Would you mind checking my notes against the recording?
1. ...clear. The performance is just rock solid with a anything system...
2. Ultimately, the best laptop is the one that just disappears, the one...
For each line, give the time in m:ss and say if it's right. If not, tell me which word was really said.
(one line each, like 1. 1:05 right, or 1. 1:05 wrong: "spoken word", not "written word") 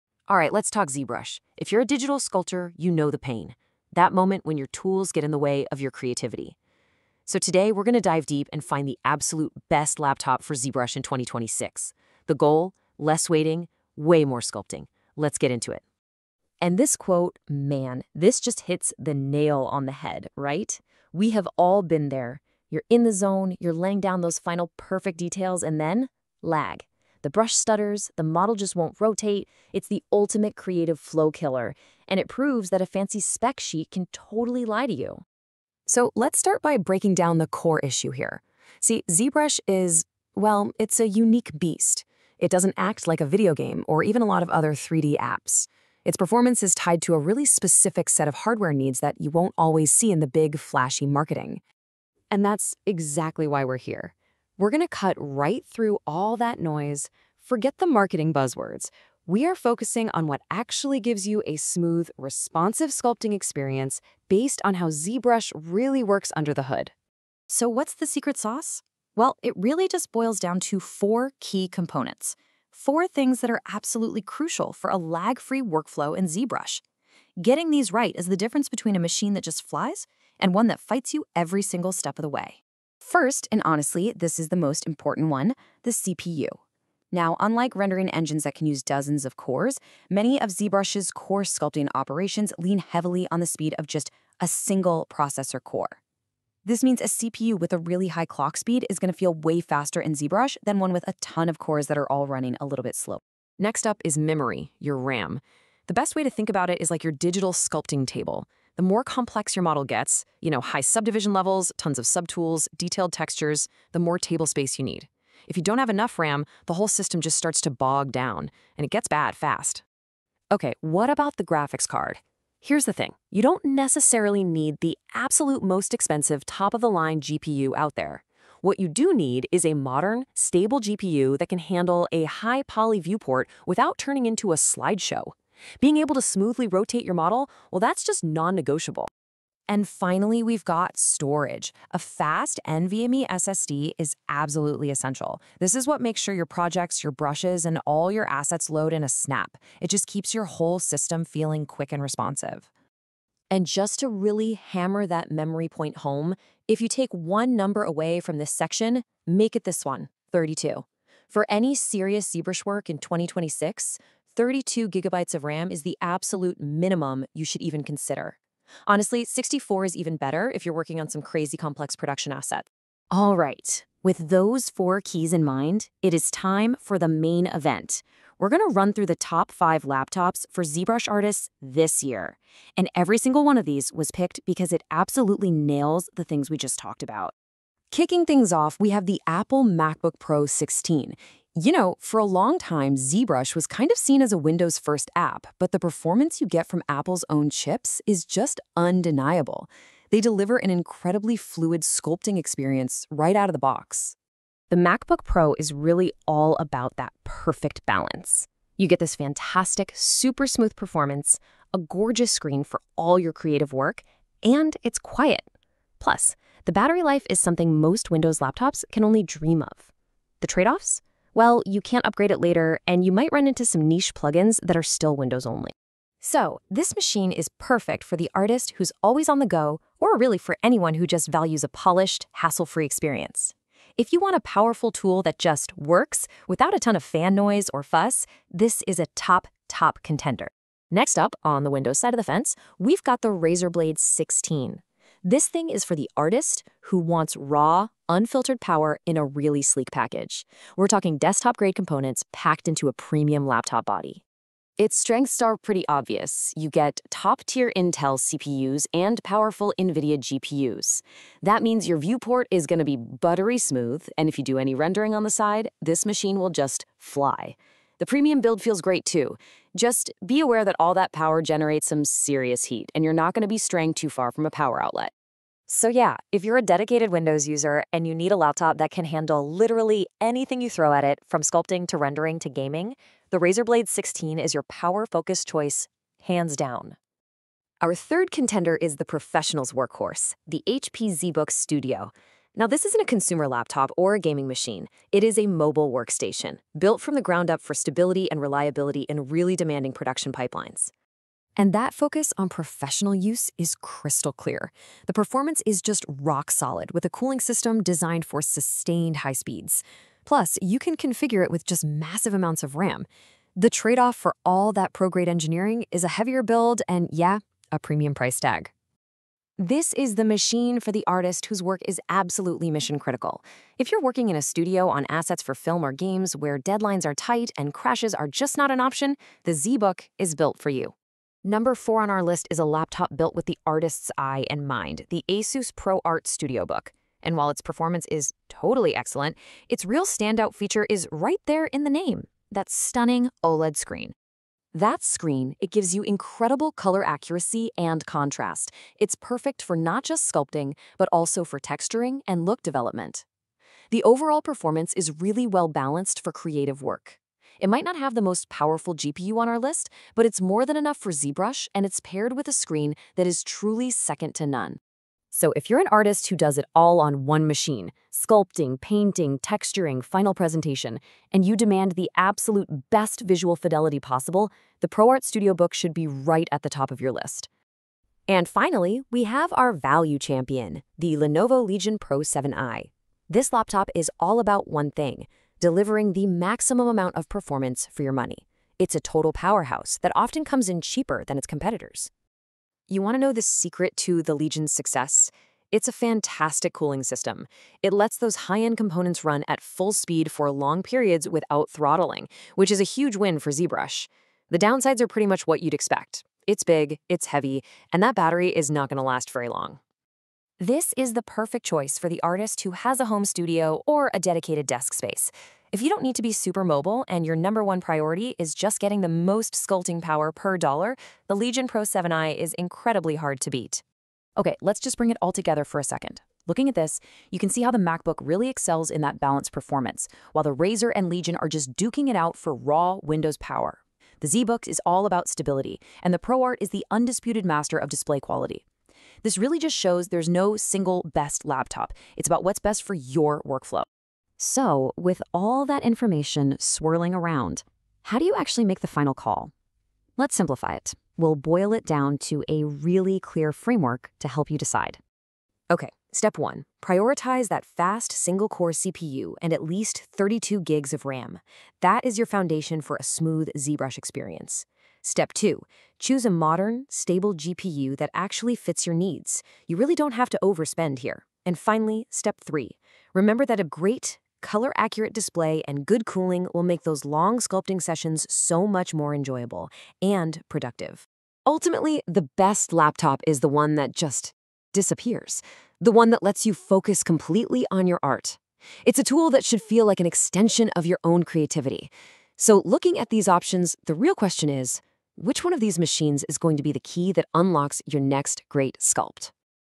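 1. 5:04 wrong: "cooling", not "anything"
2. 8:01 right.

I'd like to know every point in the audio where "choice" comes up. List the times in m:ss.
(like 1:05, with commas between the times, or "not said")
4:45, 6:51.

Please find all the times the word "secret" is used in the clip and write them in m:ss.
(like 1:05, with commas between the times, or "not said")
1:08, 6:33.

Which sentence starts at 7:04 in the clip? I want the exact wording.
Okay, let's just bring it all together for a second.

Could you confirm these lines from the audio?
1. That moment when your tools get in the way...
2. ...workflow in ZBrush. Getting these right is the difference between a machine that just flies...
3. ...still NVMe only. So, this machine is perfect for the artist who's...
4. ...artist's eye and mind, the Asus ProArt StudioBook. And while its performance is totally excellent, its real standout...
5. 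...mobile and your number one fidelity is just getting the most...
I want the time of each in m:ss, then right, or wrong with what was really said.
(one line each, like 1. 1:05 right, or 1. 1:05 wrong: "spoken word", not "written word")
1. 0:03 right
2. 1:15 right
3. 3:44 wrong: "Windows", not "NVMe"
4. 5:33 right
5. 6:56 wrong: "priority", not "fidelity".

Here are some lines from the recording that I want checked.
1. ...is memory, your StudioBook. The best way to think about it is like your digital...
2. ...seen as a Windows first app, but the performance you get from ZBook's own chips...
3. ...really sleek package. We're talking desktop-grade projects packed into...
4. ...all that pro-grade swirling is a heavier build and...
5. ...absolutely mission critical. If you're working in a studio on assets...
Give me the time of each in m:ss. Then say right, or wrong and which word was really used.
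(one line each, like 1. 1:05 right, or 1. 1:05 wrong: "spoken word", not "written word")
1. 1:44 wrong: "RAM", not "StudioBook"
2. 3:13 wrong: "Apple", not "ZBook"
3. 4:09 wrong: "components", not "projects"
4. 5:14 wrong: "engineering", not "swirling"
5. 5:22 right.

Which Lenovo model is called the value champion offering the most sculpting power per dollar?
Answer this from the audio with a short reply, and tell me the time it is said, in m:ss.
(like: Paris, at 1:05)
Lenovo Legion Pro 7i, at 6:21.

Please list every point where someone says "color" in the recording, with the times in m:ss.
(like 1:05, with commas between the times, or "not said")
5:46, 7:54.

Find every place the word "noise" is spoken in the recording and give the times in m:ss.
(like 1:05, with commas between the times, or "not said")
0:56, 3:57.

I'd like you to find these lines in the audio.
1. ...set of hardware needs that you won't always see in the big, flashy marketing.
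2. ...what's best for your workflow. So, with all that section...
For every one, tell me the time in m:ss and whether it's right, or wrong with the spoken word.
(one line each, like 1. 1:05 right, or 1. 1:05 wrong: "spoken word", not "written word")
1. 0:48 right
2. 7:22 wrong: "information", not "section".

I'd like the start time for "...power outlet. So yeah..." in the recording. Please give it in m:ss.
4:34.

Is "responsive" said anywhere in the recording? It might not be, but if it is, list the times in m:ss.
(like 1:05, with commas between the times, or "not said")
1:02, 2:32.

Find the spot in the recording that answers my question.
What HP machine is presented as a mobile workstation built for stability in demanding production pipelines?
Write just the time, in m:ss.
4:50.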